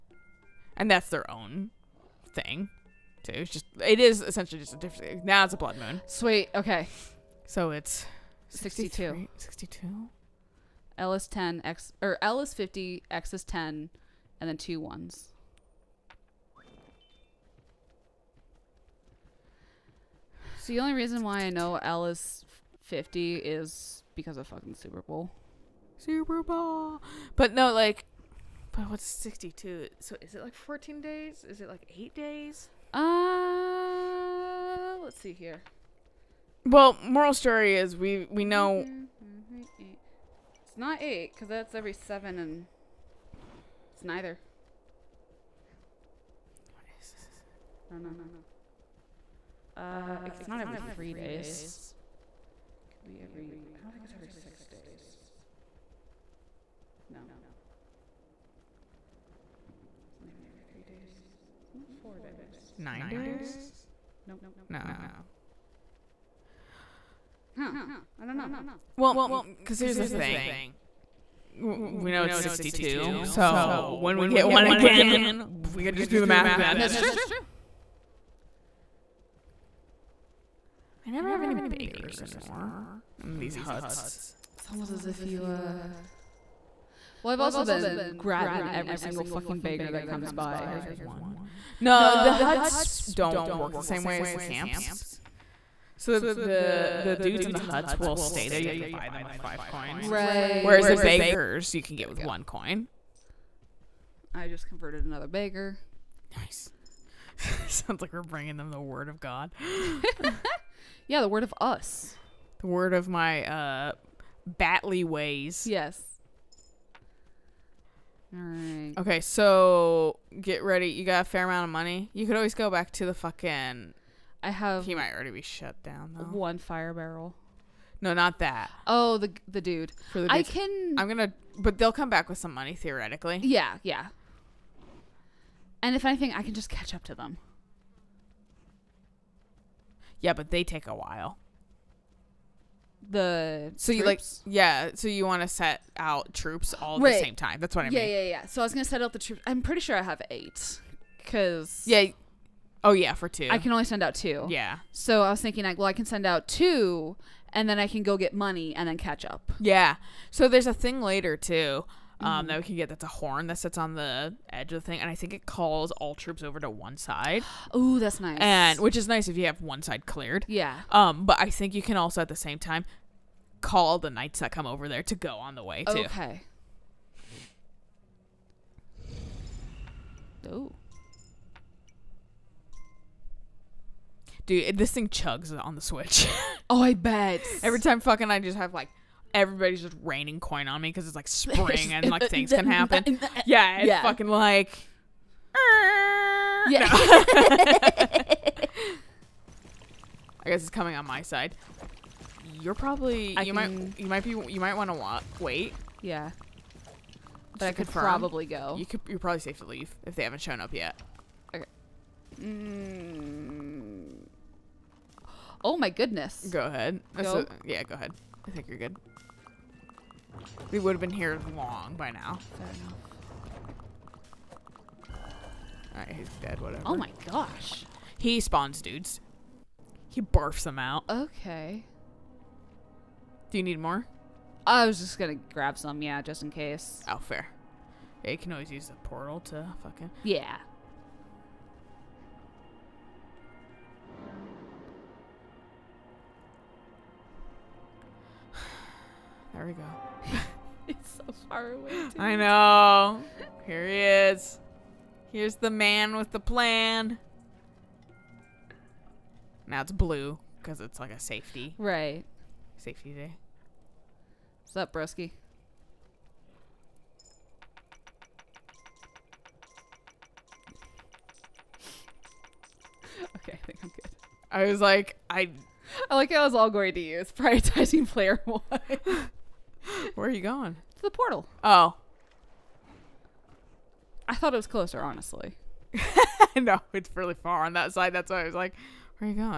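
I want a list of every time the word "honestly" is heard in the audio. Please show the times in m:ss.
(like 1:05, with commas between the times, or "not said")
4:45.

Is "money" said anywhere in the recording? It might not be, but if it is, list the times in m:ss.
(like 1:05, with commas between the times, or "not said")
2:01, 2:12, 2:38.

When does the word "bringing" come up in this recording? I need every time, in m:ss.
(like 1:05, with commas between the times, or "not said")
1:48.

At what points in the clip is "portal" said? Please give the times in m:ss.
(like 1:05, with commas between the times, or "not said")
3:59, 4:41.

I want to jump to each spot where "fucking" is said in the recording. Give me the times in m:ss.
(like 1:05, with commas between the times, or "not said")
0:24, 1:29, 2:03, 3:07, 3:14, 3:59.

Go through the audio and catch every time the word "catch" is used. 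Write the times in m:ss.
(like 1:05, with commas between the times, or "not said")
2:16, 2:38.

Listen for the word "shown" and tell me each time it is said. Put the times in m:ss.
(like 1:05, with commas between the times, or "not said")
3:30.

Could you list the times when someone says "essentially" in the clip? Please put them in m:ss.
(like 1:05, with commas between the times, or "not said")
0:04.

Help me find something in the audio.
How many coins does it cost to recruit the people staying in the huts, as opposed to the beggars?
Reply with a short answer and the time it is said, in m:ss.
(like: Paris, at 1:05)
5, at 1:39.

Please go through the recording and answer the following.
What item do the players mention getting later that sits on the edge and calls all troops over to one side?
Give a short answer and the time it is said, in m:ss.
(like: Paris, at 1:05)
A horn, at 2:43.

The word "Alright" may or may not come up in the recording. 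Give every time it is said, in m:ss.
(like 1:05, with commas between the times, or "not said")
3:45.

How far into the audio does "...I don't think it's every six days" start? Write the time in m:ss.
0:53.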